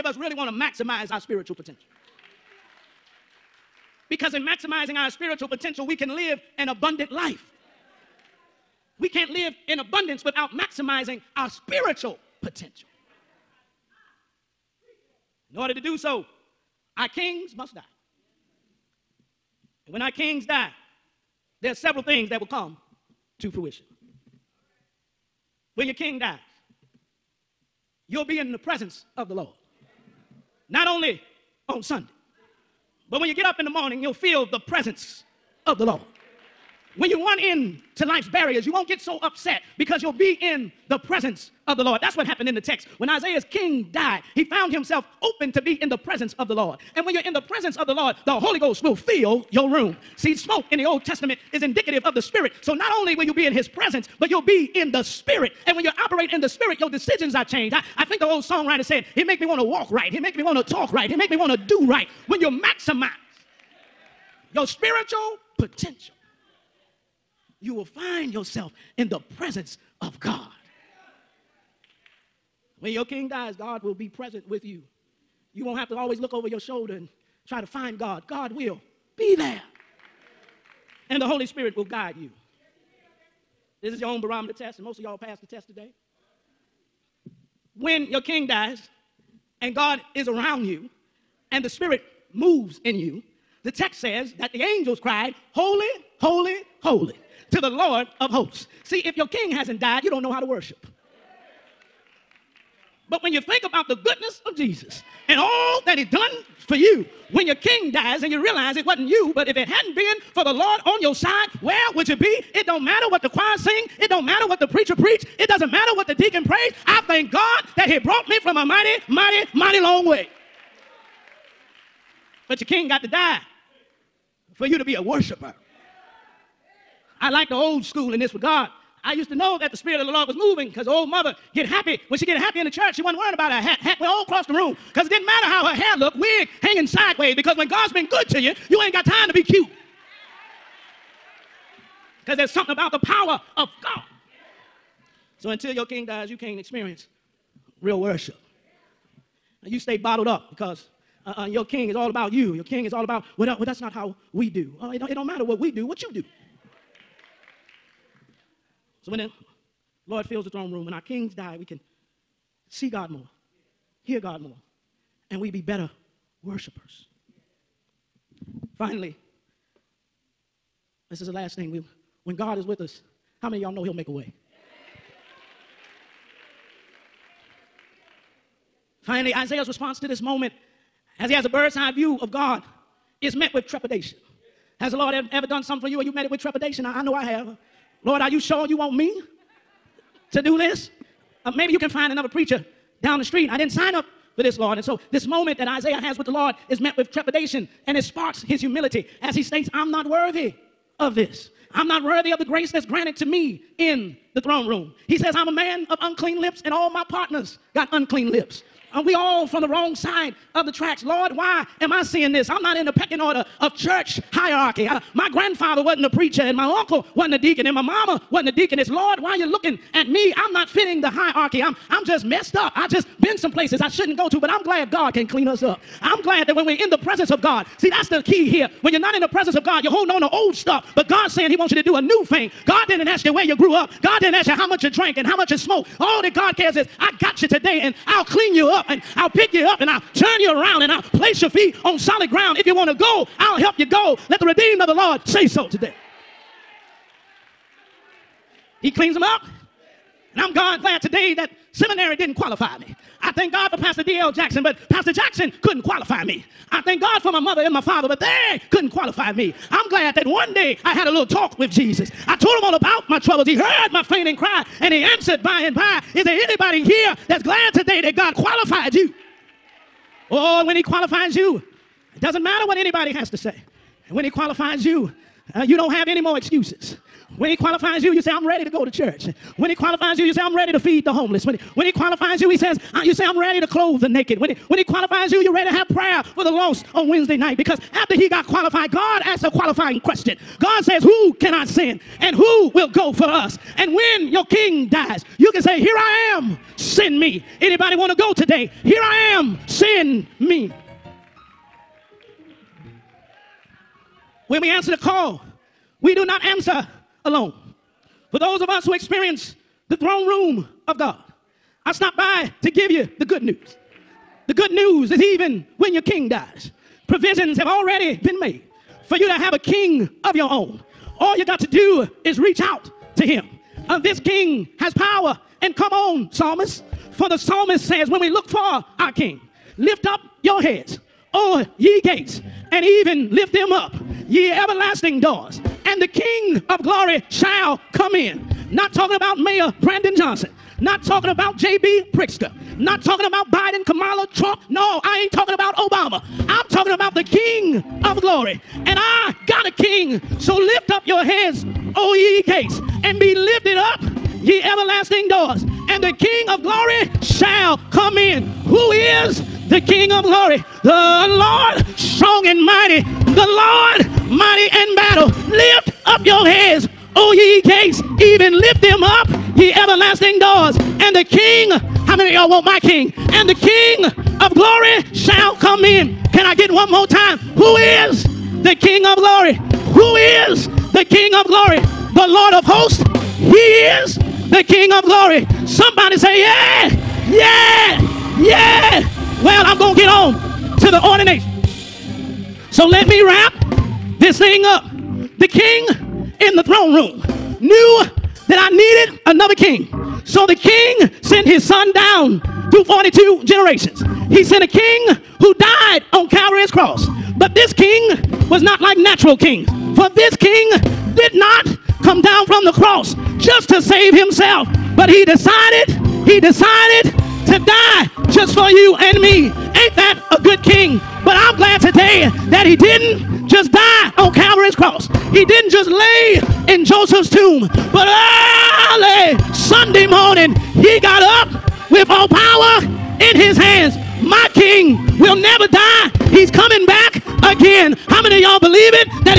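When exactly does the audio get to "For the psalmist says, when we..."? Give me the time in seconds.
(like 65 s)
327 s.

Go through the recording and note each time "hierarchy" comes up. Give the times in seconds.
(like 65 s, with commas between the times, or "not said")
214 s, 221 s.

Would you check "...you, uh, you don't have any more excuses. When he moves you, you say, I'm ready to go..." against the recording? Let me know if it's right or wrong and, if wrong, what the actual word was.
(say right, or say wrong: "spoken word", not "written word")
wrong: "qualifies", not "moves".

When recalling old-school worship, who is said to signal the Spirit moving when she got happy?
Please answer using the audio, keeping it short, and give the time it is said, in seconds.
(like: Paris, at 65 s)
Old mother, at 130 s.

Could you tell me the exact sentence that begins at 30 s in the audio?
Not only on Sunday, but when you get up in the morning, you'll feel the presence of the Lord.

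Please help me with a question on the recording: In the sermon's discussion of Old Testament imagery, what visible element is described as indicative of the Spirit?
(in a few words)
Smoke.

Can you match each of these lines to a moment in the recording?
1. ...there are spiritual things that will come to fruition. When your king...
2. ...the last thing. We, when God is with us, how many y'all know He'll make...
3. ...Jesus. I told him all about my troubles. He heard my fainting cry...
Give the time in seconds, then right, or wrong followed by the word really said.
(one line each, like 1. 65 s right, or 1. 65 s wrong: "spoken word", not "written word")
1. 21 s wrong: "several", not "spiritual"
2. 171 s right
3. 261 s right.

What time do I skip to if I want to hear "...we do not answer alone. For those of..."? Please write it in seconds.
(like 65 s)
306 s.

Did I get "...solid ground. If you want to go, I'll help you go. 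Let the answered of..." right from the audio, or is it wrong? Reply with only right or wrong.
wrong.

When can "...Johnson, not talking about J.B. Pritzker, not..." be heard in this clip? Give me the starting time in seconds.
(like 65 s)
340 s.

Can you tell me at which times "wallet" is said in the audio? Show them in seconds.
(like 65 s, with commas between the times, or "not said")
not said.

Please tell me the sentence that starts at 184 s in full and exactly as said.
Has the Lord ever done something for you and you met it with trepidation?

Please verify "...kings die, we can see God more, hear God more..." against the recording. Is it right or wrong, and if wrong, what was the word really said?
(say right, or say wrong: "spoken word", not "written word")
right.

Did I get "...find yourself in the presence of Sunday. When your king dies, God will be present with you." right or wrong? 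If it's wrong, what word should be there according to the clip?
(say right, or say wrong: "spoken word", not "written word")
wrong: "God", not "Sunday".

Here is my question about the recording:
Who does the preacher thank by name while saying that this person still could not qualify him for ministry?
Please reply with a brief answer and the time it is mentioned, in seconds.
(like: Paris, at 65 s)
Pastor D.L. Jackson, at 253 s.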